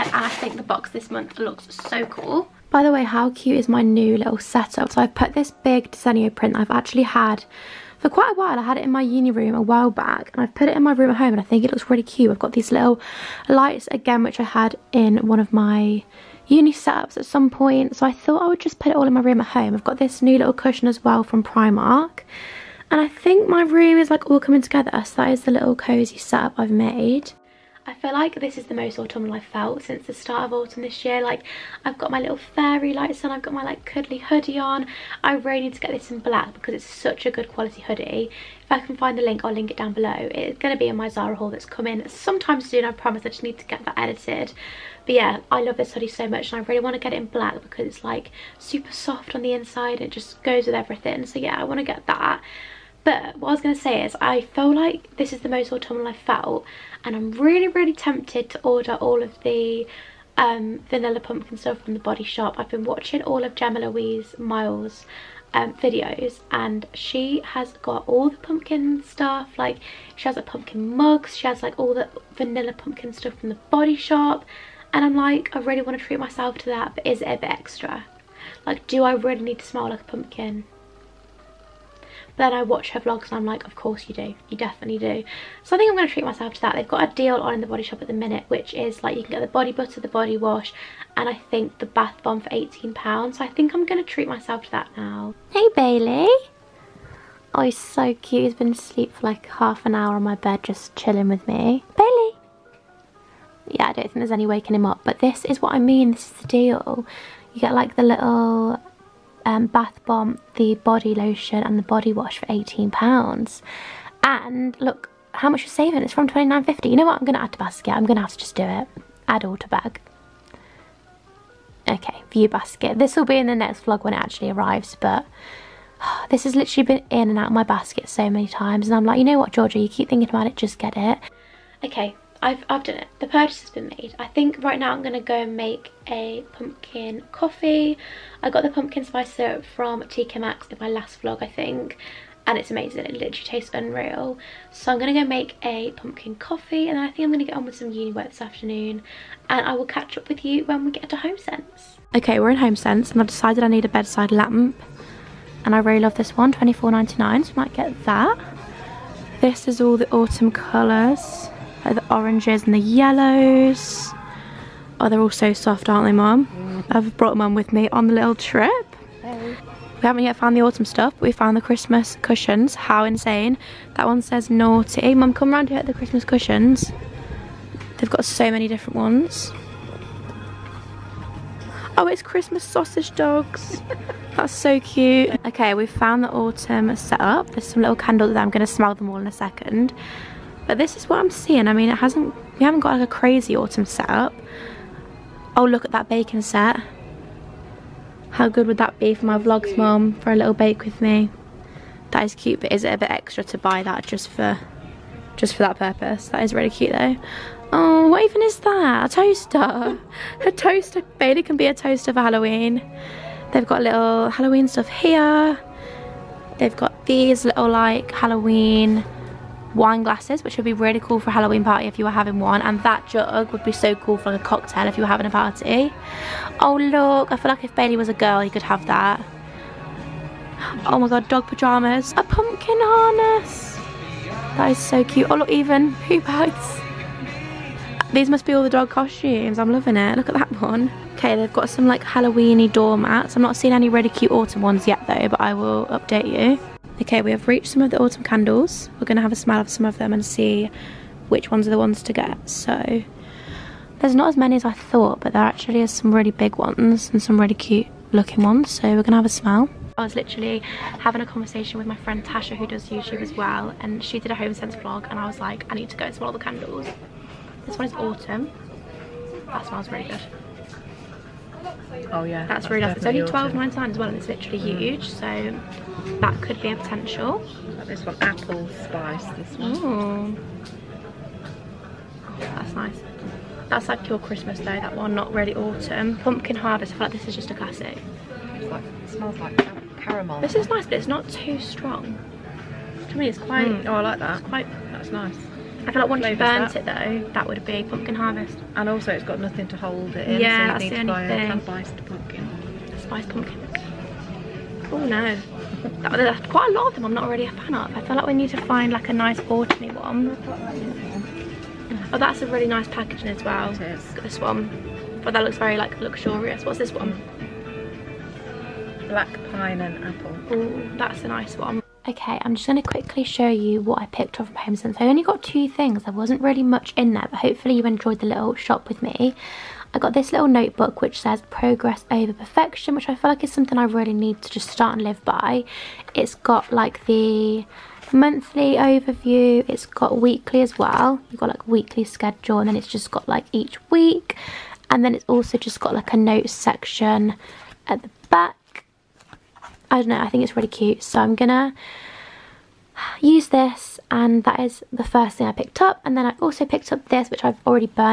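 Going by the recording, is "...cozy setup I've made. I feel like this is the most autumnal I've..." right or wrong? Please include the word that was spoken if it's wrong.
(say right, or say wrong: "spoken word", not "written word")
right.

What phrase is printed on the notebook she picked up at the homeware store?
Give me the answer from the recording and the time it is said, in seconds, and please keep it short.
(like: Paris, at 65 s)
progress over perfection, at 331 s.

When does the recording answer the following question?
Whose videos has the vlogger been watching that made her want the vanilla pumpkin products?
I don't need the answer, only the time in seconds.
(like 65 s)
63 s.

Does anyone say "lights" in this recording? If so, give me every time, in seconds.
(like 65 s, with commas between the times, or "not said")
13 s, 32 s.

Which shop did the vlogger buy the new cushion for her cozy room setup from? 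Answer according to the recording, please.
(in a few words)
Primark.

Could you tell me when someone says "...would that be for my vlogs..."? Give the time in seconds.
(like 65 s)
198 s.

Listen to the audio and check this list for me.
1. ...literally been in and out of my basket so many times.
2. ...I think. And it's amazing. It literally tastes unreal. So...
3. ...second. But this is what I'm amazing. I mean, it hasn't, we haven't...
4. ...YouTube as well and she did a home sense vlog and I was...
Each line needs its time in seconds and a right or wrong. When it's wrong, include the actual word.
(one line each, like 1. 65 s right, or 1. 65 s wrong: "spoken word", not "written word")
1. 126 s right
2. 141 s right
3. 189 s wrong: "seeing", not "amazing"
4. 262 s right.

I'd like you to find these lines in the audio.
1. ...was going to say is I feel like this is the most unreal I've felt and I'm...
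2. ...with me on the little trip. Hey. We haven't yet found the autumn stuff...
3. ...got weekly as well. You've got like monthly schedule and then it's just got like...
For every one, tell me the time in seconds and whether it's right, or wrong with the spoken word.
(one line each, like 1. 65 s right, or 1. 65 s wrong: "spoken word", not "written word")
1. 53 s wrong: "autumnal", not "unreal"
2. 167 s right
3. 339 s wrong: "weekly", not "monthly".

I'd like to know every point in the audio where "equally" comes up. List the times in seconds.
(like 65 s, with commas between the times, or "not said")
not said.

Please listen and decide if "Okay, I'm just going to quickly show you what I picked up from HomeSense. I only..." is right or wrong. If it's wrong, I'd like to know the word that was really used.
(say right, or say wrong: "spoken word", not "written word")
right.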